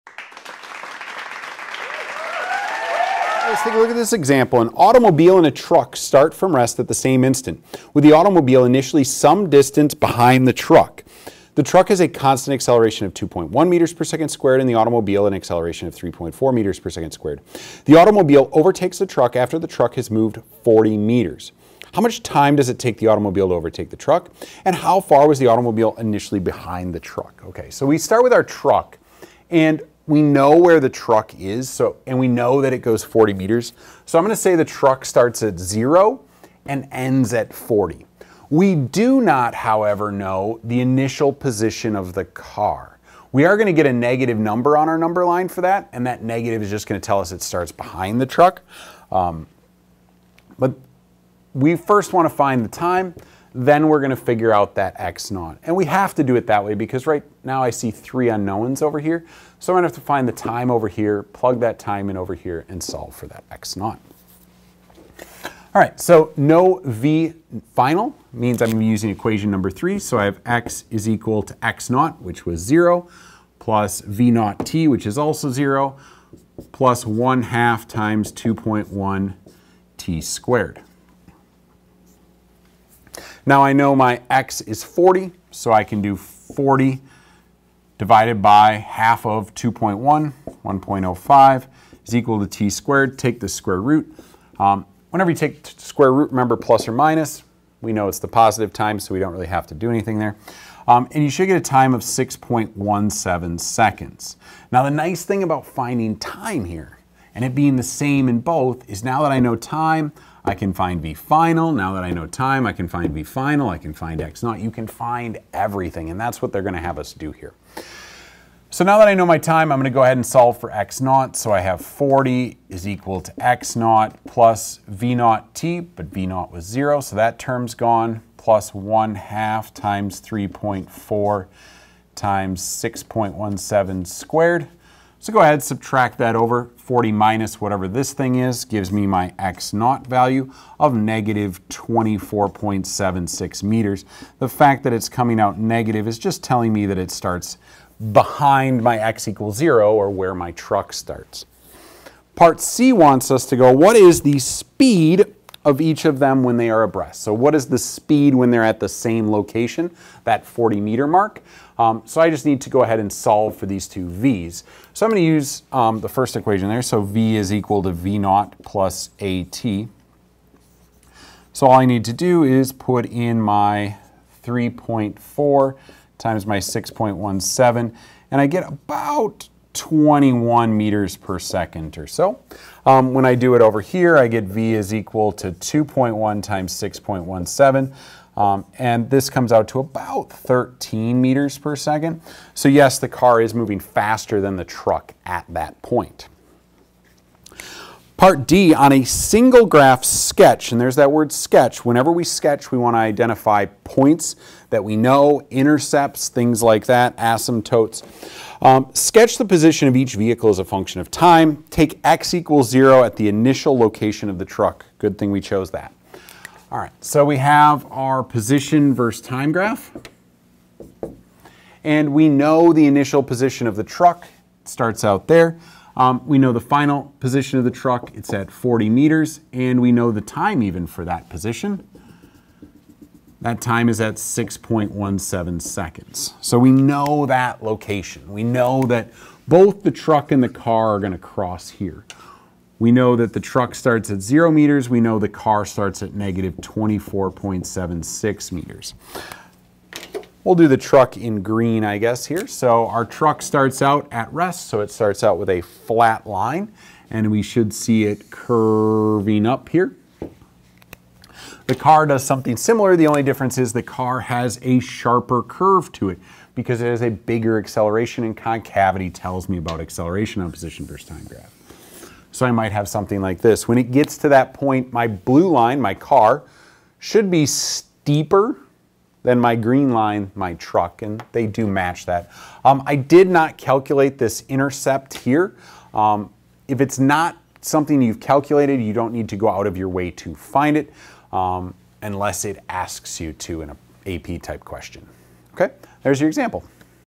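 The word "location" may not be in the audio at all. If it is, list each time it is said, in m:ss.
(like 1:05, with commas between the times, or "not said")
2:39, 3:33, 3:57.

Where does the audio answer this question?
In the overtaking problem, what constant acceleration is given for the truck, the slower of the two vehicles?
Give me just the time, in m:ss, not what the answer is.
0:13.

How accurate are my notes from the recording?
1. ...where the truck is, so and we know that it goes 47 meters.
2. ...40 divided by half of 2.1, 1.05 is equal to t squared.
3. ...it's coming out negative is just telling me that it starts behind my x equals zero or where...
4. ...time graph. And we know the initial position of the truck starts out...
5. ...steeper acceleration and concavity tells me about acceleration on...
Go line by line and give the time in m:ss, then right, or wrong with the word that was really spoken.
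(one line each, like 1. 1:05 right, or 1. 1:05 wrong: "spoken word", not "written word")
1. 0:30 wrong: "40", not "47"
2. 1:26 right
3. 2:24 right
4. 3:39 right
5. 4:27 wrong: "bigger", not "steeper".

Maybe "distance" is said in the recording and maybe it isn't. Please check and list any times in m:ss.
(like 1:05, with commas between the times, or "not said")
0:09.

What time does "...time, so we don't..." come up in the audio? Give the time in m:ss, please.
1:38.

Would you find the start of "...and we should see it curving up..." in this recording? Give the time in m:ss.
4:17.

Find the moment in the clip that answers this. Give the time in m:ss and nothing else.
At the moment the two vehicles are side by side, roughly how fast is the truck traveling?
3:10.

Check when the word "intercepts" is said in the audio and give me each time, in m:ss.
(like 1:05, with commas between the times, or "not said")
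3:25, 4:44.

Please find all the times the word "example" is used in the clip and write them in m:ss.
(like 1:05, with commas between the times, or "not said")
0:04, 4:56.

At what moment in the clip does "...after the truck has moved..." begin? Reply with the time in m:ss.
0:19.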